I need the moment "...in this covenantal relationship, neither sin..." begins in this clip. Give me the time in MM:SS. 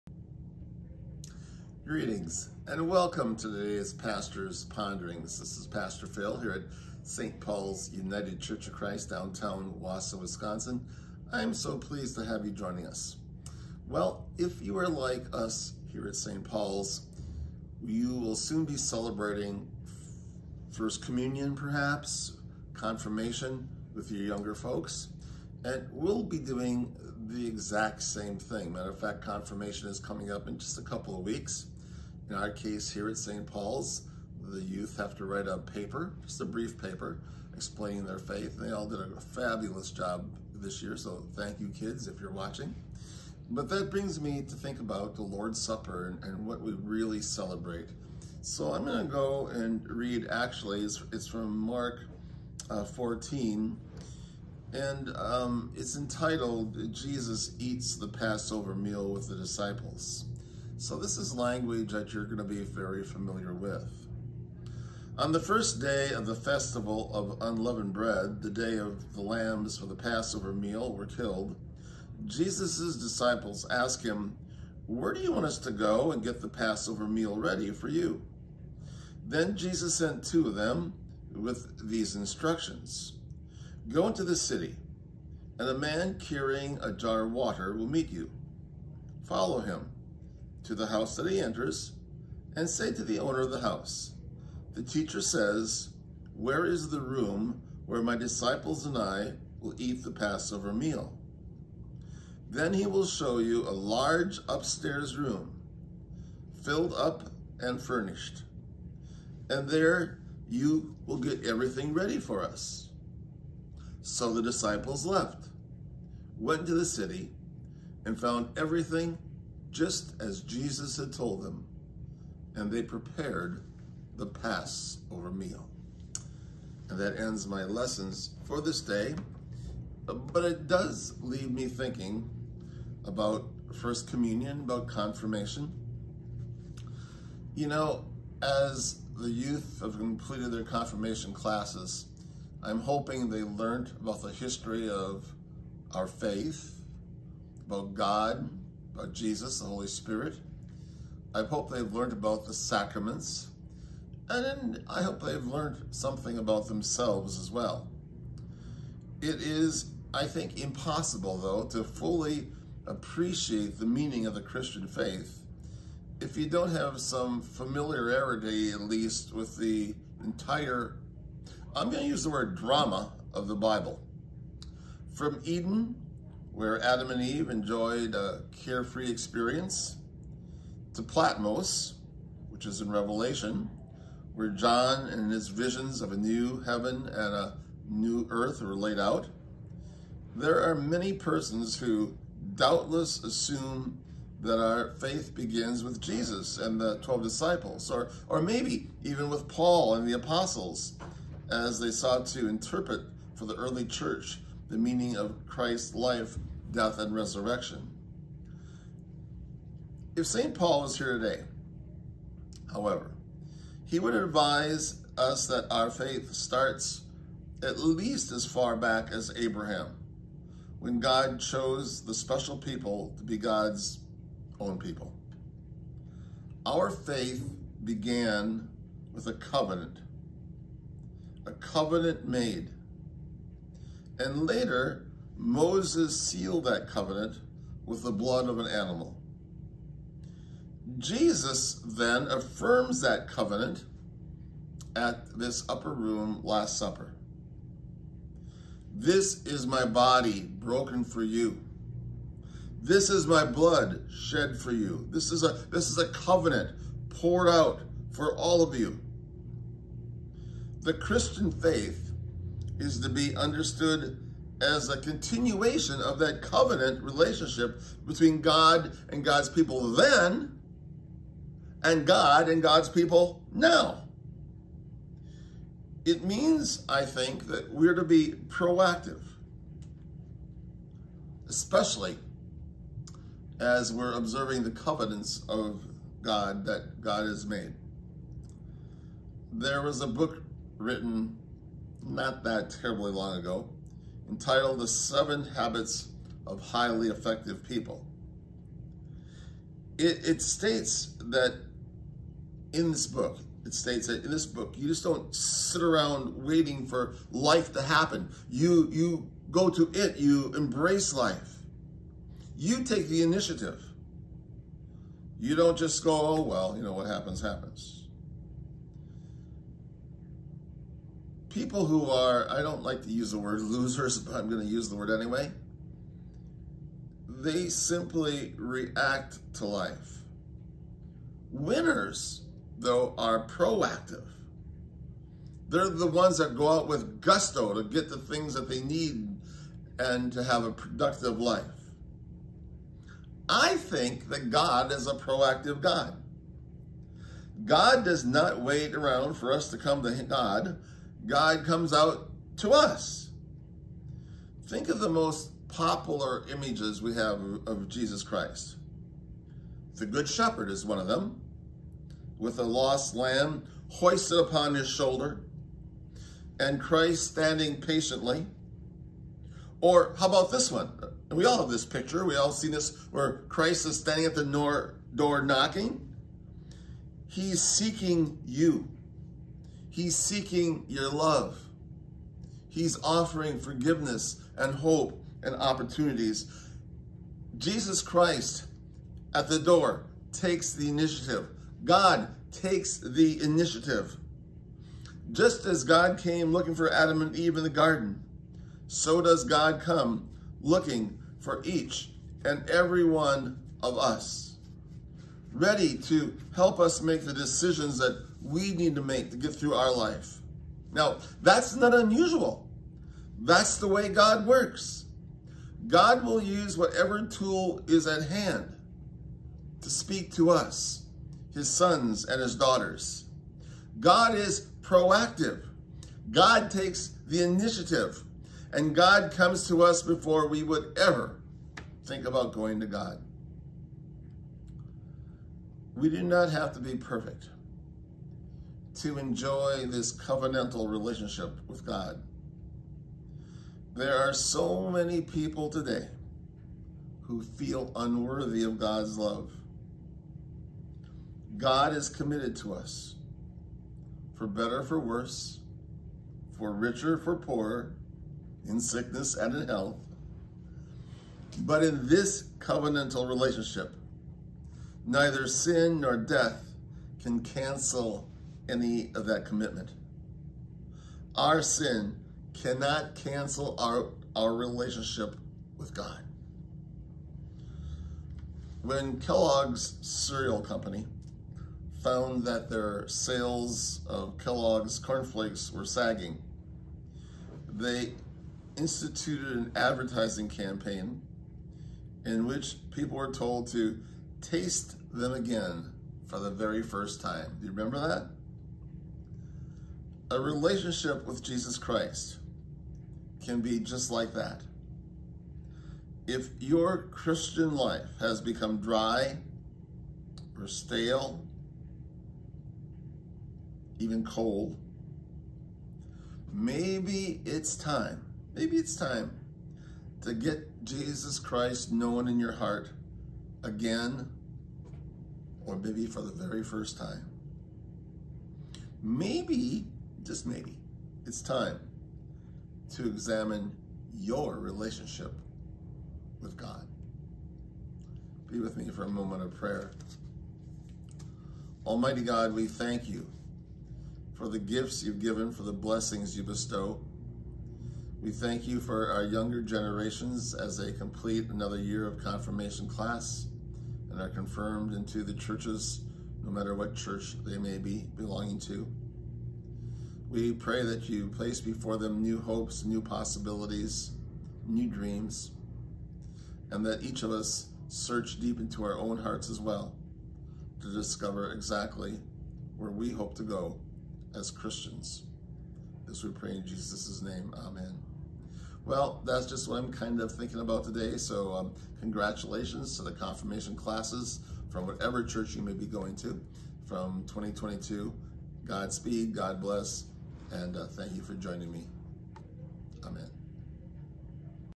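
07:41.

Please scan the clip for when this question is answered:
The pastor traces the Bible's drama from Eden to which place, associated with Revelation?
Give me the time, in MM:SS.
03:01.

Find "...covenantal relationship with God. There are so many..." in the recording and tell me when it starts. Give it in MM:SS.
07:20.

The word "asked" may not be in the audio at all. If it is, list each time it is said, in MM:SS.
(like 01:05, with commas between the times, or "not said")
01:13.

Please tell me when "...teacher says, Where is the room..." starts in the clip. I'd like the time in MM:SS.
01:34.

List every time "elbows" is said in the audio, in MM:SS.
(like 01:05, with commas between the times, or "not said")
not said.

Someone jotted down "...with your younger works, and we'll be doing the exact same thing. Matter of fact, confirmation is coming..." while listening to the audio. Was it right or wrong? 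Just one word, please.
wrong.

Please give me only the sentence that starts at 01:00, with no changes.
So this is language that you're going to be very familiar with.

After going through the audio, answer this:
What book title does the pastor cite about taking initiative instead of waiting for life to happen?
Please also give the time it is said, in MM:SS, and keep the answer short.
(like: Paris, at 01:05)
The Seven Habits of Highly Effective People, at 04:54.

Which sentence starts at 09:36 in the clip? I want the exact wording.
This we pray in Jesus' name.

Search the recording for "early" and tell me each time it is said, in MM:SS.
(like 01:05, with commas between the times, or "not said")
03:23.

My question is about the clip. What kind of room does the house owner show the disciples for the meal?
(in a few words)
A large upstairs room.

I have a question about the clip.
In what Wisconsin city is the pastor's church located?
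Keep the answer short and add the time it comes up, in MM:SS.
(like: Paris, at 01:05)
Wausau, at 00:09.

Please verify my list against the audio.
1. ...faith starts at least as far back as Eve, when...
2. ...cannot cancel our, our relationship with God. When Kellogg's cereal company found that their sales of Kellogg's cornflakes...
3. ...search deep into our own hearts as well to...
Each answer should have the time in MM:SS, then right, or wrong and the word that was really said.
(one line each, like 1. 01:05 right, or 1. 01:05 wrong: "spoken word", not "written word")
1. 03:35 wrong: "Abraham", not "Eve"
2. 07:52 right
3. 09:27 right.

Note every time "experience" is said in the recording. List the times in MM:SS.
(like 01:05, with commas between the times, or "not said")
02:59.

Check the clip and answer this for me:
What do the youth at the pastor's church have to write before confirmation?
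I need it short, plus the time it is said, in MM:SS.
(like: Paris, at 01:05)
A brief paper, at 00:36.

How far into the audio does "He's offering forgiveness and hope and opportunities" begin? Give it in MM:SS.
06:22.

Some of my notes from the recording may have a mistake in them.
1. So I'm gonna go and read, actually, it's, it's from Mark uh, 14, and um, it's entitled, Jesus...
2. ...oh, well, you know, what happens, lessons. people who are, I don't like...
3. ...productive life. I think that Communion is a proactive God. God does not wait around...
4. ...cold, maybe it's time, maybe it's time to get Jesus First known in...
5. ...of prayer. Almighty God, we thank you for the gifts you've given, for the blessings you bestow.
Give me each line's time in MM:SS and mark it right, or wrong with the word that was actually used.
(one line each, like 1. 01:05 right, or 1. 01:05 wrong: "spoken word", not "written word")
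1. 00:48 right
2. 05:16 wrong: "happens", not "lessons"
3. 05:40 wrong: "God", not "Communion"
4. 08:34 wrong: "Christ", not "First"
5. 08:59 right.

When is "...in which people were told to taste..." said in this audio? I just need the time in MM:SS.
08:12.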